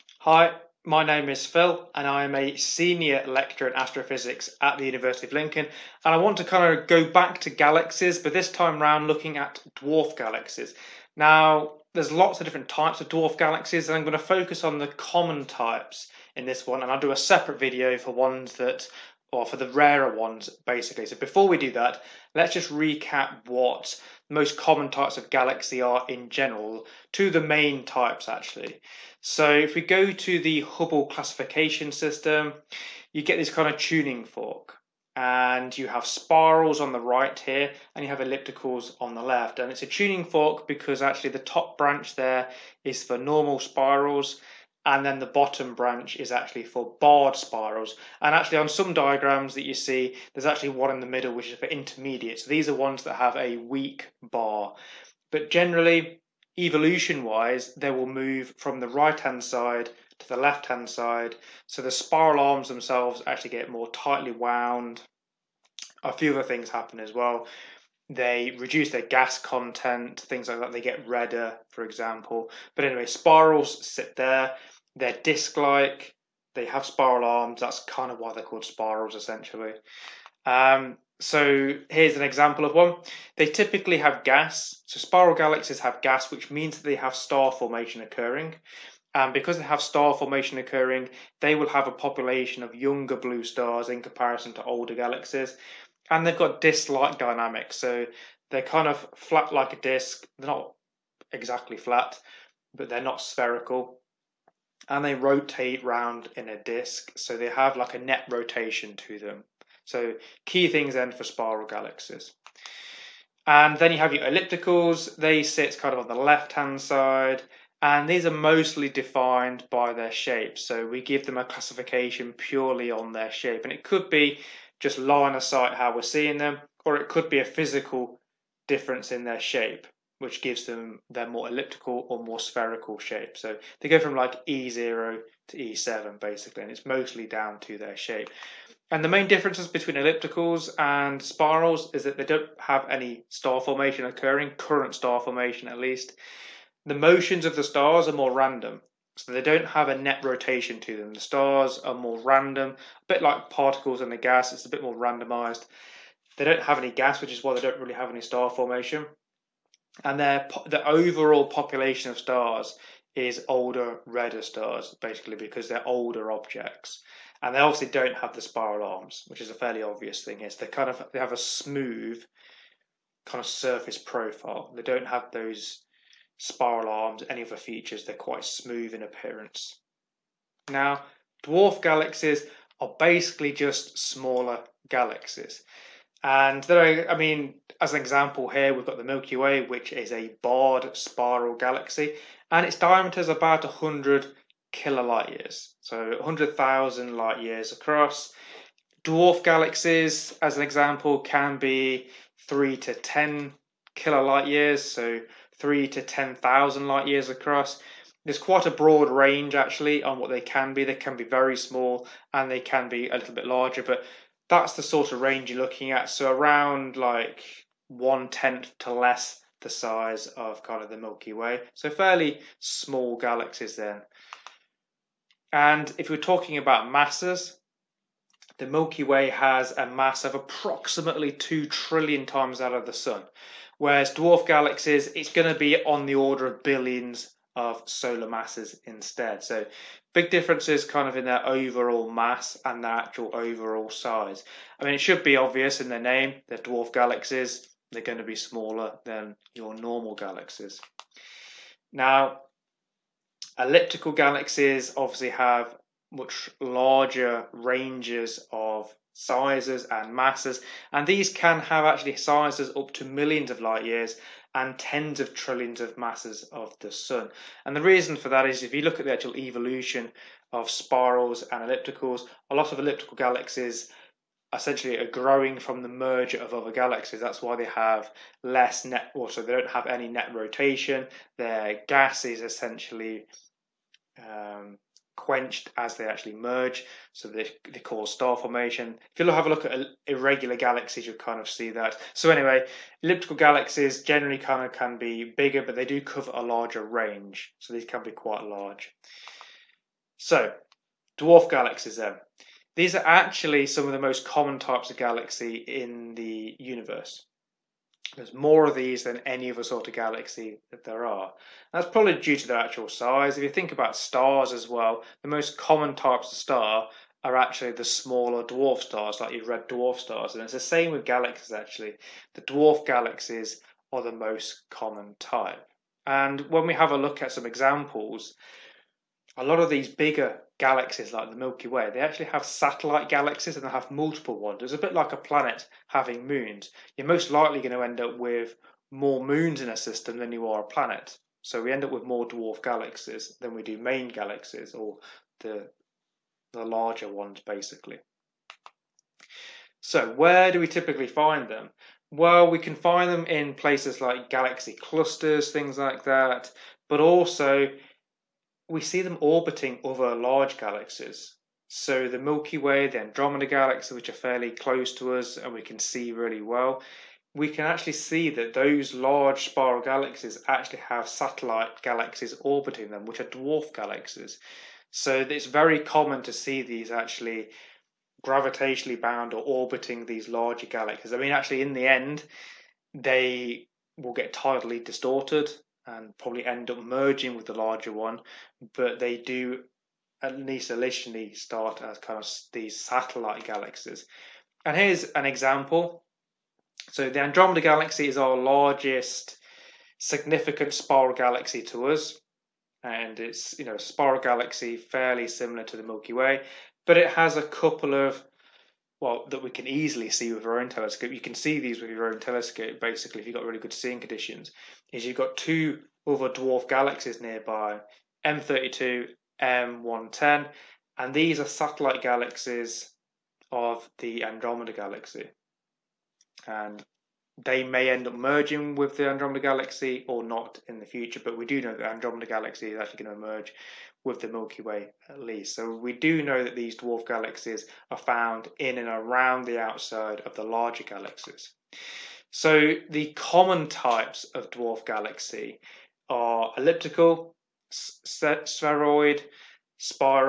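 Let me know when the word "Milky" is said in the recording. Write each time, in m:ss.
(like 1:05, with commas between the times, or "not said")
3:09, 3:40, 3:48, 5:31, 6:02, 6:45, 7:14.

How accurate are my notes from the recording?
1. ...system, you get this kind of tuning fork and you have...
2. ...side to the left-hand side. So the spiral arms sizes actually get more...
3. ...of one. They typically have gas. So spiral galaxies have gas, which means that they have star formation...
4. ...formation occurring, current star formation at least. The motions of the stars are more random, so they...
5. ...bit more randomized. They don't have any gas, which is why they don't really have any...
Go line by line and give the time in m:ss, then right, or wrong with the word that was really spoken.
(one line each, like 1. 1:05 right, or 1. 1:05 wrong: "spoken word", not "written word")
1. 0:31 right
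2. 0:59 wrong: "themselves", not "sizes"
3. 1:22 right
4. 2:23 right
5. 2:34 right.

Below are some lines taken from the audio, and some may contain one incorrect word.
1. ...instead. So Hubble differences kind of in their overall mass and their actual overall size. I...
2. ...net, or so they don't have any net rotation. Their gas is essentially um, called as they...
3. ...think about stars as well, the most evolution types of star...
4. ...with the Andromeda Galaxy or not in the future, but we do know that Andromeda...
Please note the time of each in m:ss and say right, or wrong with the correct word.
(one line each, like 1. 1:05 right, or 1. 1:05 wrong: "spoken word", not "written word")
1. 3:58 wrong: "Big", not "Hubble"
2. 4:38 wrong: "quenched", not "called"
3. 5:13 wrong: "common", not "evolution"
4. 7:08 right.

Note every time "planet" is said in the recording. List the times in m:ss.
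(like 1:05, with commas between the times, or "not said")
5:35, 5:40.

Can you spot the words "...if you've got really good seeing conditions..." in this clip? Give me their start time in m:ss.
6:53.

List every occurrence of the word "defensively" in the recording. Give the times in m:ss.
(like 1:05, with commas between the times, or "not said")
not said.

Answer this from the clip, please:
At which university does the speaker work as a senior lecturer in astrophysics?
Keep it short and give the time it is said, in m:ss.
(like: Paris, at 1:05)
University of Lincoln, at 0:04.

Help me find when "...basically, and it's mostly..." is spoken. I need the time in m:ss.
2:16.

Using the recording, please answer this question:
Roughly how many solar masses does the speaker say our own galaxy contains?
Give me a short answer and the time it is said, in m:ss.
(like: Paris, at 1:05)
2 trillion, at 3:51.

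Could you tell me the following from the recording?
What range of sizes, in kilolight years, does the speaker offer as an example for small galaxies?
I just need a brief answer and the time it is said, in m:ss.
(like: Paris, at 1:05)
3 to 10 kilolight years, at 3:22.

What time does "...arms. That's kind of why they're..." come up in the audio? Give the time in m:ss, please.
1:17.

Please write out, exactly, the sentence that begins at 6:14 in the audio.
So it's very common to see these actually gravitationally bound or orbiting these larger galaxies.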